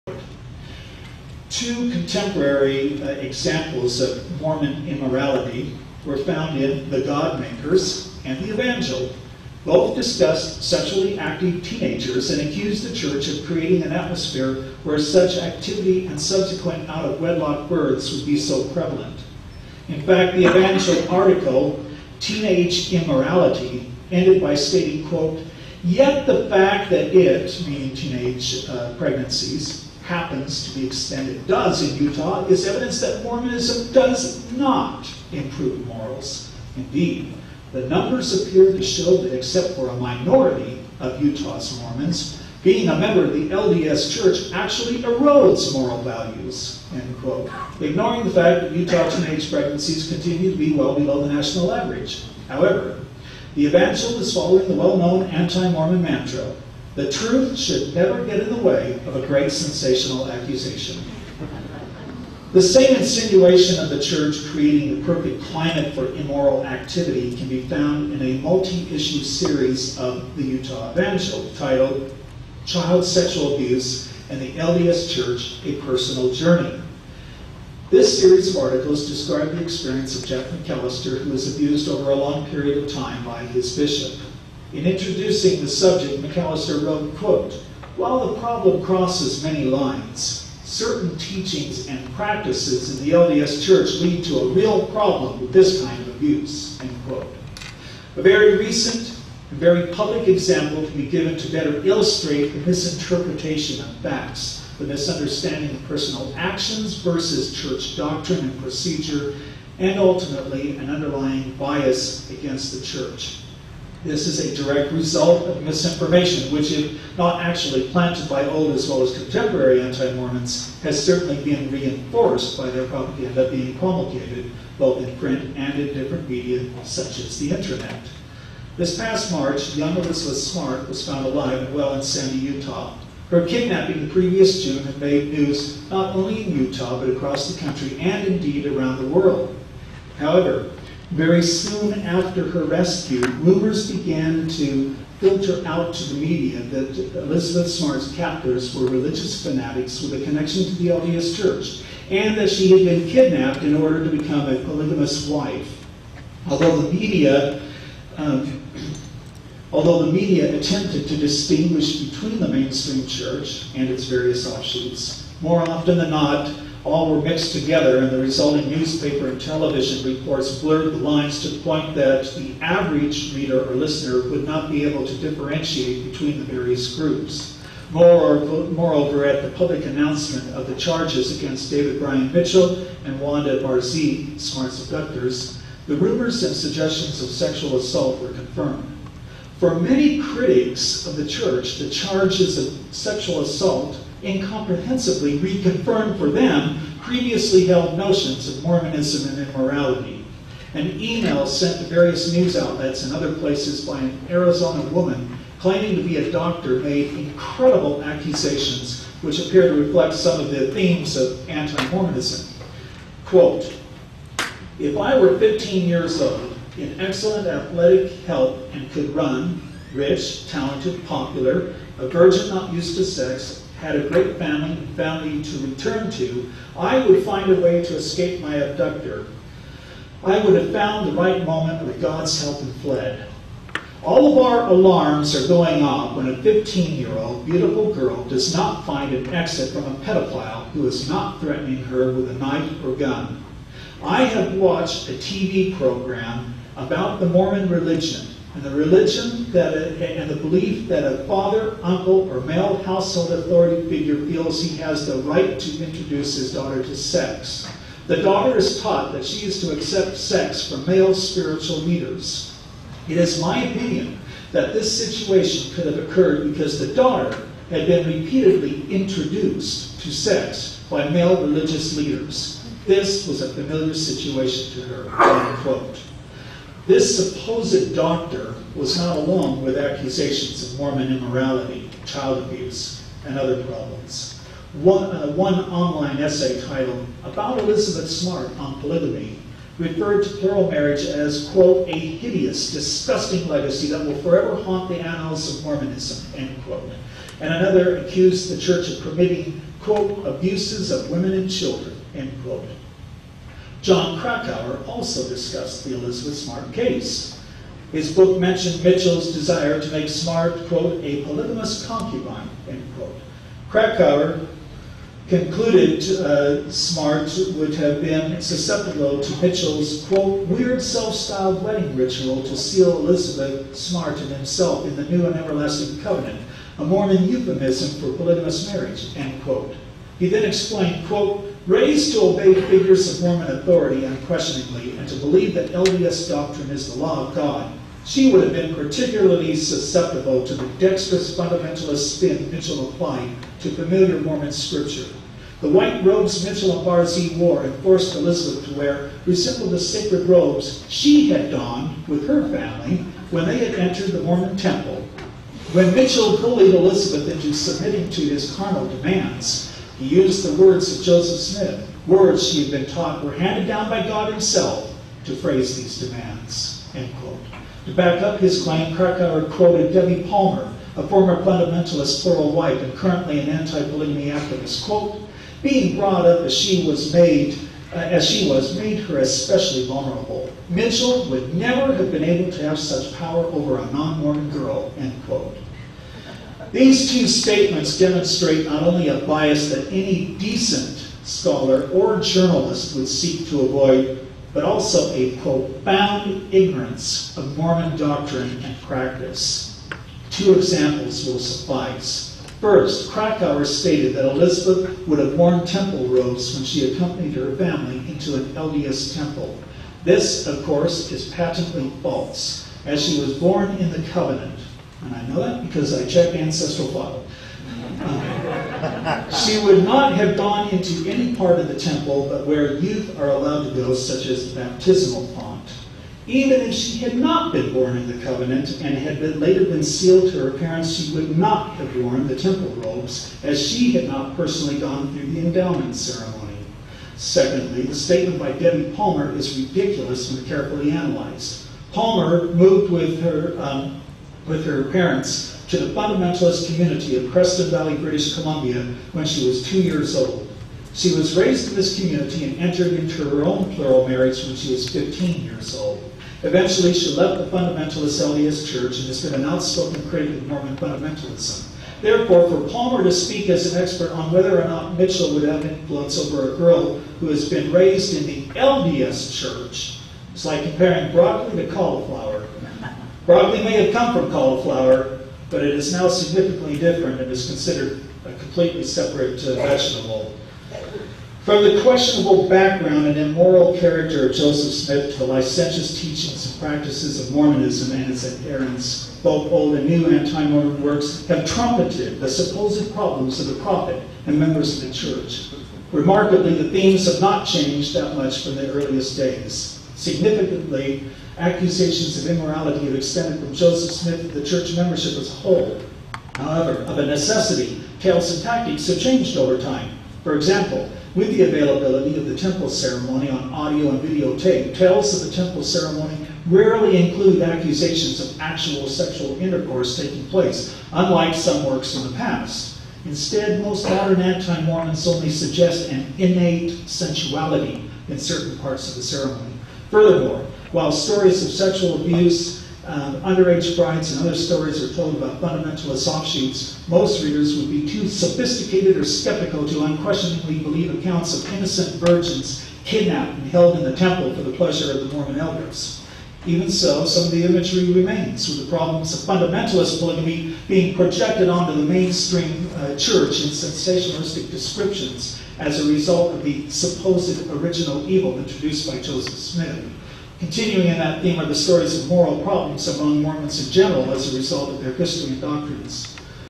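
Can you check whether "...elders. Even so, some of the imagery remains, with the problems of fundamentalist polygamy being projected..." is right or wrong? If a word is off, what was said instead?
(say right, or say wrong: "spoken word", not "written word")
right.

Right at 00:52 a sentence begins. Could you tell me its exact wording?
However, the evangelist is following the well-known anti-Mormon mantra, the truth should never get in the way of a great sensational accusation.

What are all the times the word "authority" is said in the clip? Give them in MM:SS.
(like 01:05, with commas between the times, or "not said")
04:13, 05:33.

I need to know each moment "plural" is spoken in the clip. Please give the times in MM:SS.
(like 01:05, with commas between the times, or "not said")
04:50, 06:12, 07:33.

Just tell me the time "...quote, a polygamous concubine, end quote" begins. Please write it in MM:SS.
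05:10.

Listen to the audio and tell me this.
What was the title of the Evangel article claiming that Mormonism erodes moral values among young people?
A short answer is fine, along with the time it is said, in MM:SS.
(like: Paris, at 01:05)
Teenage Immorality, at 00:22.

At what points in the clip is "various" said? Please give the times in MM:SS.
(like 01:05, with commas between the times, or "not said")
02:44, 02:56, 03:21.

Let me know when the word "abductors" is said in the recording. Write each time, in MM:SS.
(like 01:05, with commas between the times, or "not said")
03:04, 03:48.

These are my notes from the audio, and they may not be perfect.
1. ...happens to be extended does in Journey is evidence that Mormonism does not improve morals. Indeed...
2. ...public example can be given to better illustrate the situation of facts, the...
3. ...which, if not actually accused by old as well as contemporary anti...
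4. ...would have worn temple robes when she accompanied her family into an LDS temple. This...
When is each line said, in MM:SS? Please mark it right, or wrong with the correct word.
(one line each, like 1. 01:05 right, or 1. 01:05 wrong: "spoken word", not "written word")
1. 00:30 wrong: "Utah", not "Journey"
2. 01:39 wrong: "misinterpretation", not "situation"
3. 01:56 wrong: "planted", not "accused"
4. 06:45 right.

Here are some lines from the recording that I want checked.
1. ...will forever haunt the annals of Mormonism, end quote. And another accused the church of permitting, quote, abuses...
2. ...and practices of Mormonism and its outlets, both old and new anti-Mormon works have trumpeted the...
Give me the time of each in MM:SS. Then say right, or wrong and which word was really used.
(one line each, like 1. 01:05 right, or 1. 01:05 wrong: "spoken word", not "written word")
1. 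04:54 right
2. 08:06 wrong: "adherents", not "outlets".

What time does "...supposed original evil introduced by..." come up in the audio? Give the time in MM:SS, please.
09:16.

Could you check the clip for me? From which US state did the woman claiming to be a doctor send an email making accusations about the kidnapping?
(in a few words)
Arizona.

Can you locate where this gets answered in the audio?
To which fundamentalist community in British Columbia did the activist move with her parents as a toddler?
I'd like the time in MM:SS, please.
07:27.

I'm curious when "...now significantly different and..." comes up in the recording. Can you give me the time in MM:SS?
07:55.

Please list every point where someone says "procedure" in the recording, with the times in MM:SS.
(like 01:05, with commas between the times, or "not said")
01:48.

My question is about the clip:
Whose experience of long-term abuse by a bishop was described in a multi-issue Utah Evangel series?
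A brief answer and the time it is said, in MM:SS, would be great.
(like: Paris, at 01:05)
Jeff McAllister, at 01:20.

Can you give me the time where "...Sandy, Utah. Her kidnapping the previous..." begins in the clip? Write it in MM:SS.
02:12.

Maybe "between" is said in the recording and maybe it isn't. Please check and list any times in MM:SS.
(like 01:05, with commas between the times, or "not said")
02:42, 02:56.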